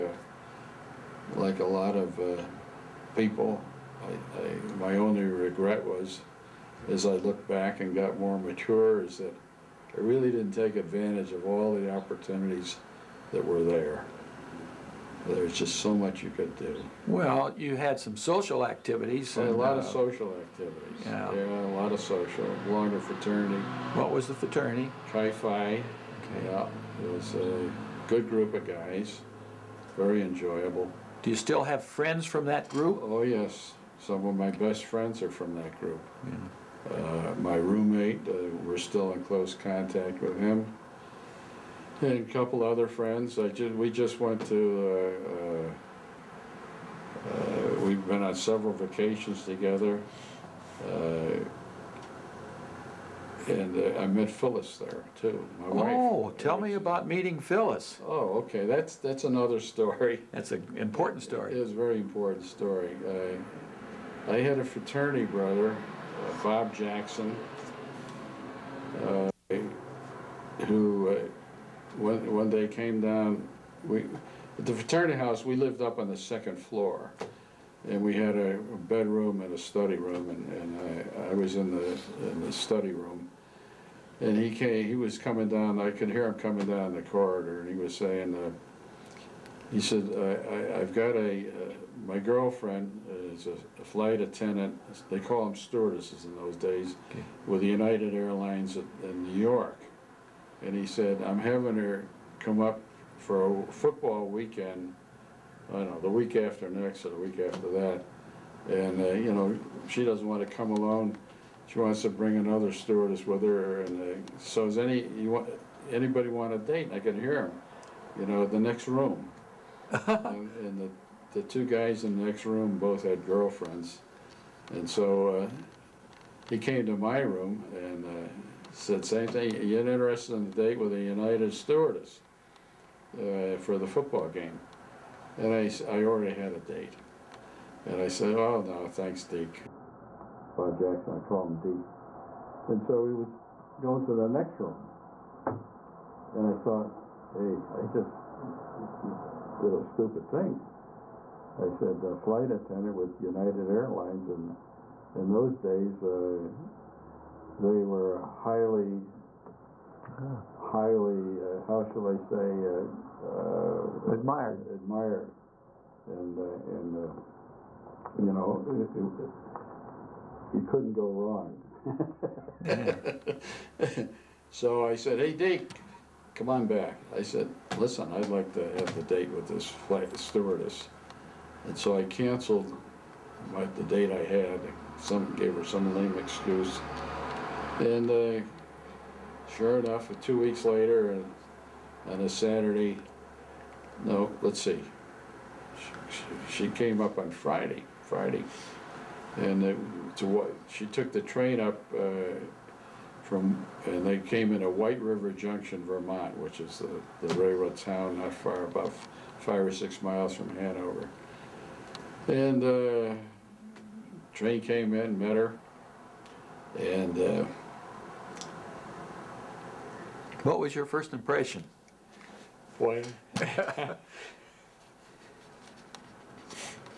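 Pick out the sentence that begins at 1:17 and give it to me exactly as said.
And we had a bedroom and a study room, and, and I, I was in the, in the study room.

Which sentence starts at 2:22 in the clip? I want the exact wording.
And so he was going to the next room.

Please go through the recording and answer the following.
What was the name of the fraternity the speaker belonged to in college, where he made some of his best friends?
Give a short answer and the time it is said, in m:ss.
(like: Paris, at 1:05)
Chi Phi, at 0:25.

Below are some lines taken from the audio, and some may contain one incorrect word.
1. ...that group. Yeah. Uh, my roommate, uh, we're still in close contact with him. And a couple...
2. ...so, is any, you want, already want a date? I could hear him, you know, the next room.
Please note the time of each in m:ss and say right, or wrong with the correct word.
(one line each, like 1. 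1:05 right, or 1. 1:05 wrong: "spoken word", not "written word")
1. 0:35 right
2. 1:54 wrong: "anybody", not "already".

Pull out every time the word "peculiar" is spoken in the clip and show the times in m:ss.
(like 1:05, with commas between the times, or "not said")
not said.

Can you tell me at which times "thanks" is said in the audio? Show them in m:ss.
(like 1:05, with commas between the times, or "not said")
2:18.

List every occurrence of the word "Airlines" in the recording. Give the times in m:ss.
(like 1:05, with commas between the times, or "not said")
1:38, 2:33.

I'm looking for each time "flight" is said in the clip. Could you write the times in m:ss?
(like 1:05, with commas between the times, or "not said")
1:33, 2:32, 2:59.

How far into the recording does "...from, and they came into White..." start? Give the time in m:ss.
3:23.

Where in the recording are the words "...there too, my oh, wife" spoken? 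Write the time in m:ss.
0:54.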